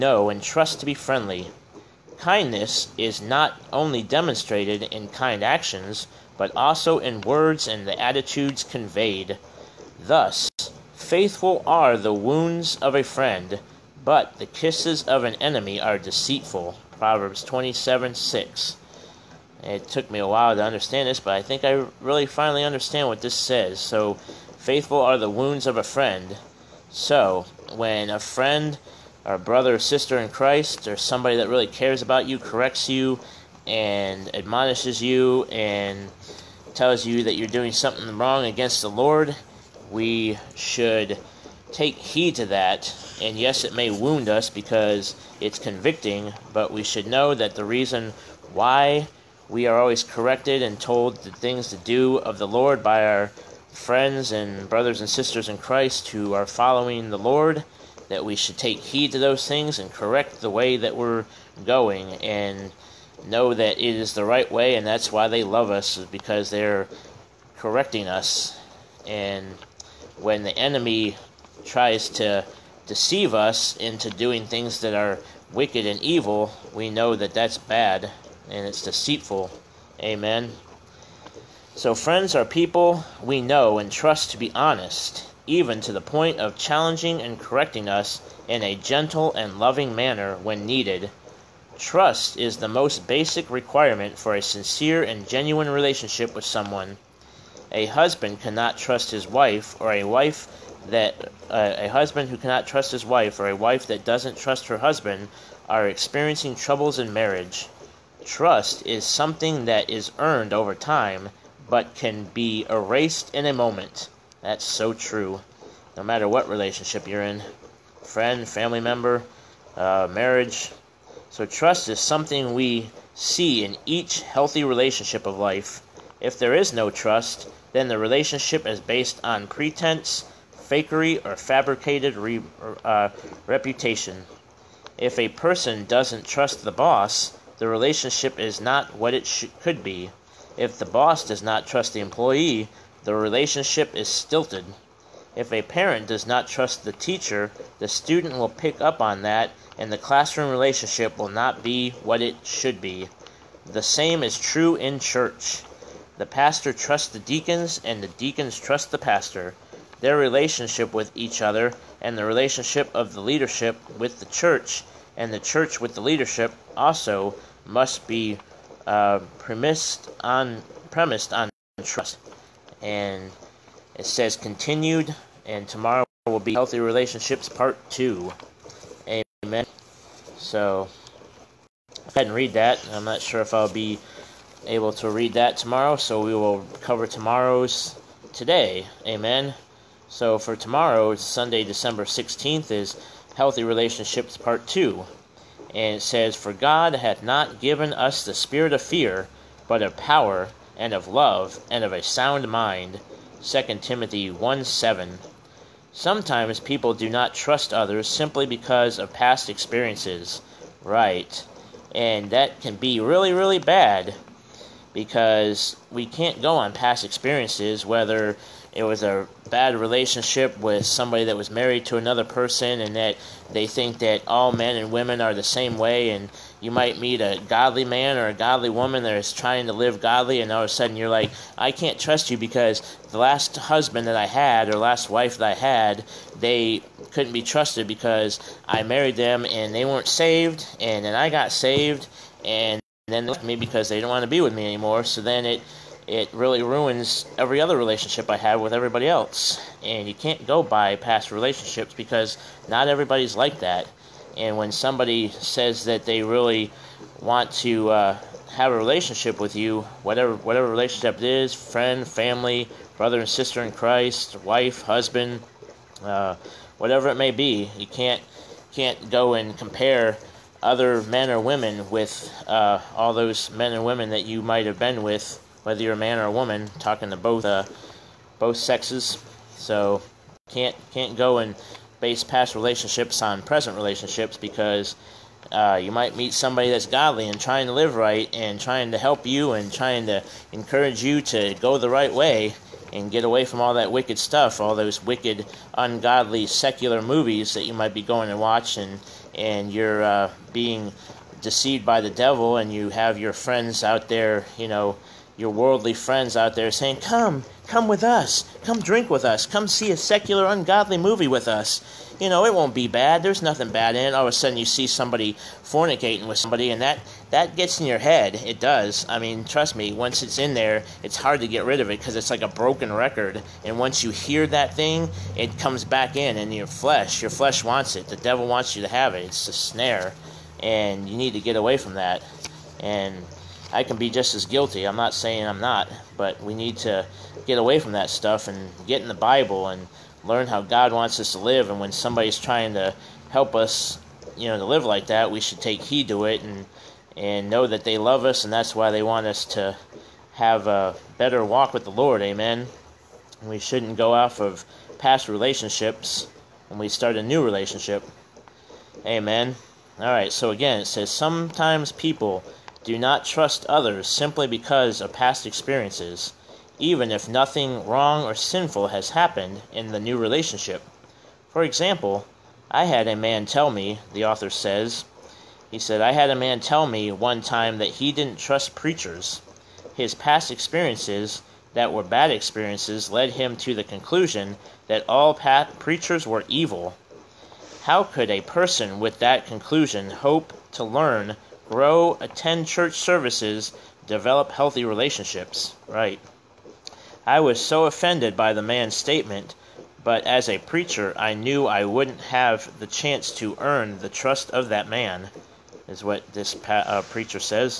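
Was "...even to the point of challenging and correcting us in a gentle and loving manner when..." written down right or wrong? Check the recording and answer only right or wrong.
right.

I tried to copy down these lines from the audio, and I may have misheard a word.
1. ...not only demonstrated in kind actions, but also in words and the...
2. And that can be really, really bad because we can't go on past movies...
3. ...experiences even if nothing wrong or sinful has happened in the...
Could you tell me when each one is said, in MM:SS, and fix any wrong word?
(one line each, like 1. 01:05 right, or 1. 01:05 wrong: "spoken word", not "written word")
1. 00:03 right
2. 03:31 wrong: "experiences", not "movies"
3. 06:05 right.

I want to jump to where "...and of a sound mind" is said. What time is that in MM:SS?
03:21.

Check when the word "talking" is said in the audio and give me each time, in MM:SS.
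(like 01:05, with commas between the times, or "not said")
04:36.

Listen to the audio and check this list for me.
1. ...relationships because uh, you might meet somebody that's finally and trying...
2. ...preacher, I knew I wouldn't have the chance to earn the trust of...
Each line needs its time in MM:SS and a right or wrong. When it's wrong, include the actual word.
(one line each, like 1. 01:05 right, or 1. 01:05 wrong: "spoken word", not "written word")
1. 04:43 wrong: "godly", not "finally"
2. 06:40 right.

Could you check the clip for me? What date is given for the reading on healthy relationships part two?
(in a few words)
Sunday, December 16th.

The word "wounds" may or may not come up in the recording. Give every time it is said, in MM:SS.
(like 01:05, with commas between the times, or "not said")
00:12, 00:25, 00:43.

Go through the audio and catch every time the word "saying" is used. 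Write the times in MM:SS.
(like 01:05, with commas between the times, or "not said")
05:06, 05:35.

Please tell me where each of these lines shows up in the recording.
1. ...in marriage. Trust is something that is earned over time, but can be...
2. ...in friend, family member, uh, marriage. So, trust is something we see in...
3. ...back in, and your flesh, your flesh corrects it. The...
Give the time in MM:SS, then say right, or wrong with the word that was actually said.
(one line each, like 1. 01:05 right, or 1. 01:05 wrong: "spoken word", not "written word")
1. 01:46 right
2. 01:57 right
3. 05:25 wrong: "wants", not "corrects".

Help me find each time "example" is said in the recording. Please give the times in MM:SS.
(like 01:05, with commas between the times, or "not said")
06:11.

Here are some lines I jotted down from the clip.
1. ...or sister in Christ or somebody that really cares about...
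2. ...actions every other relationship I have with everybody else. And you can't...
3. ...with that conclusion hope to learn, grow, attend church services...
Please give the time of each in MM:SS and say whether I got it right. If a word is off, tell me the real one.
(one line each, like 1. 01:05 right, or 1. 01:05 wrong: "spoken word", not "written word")
1. 00:29 right
2. 04:06 wrong: "ruins", not "actions"
3. 06:28 right.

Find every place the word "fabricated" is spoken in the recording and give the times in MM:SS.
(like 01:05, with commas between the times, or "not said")
02:11.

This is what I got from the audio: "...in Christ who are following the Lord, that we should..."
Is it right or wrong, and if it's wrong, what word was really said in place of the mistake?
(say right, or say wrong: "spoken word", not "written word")
right.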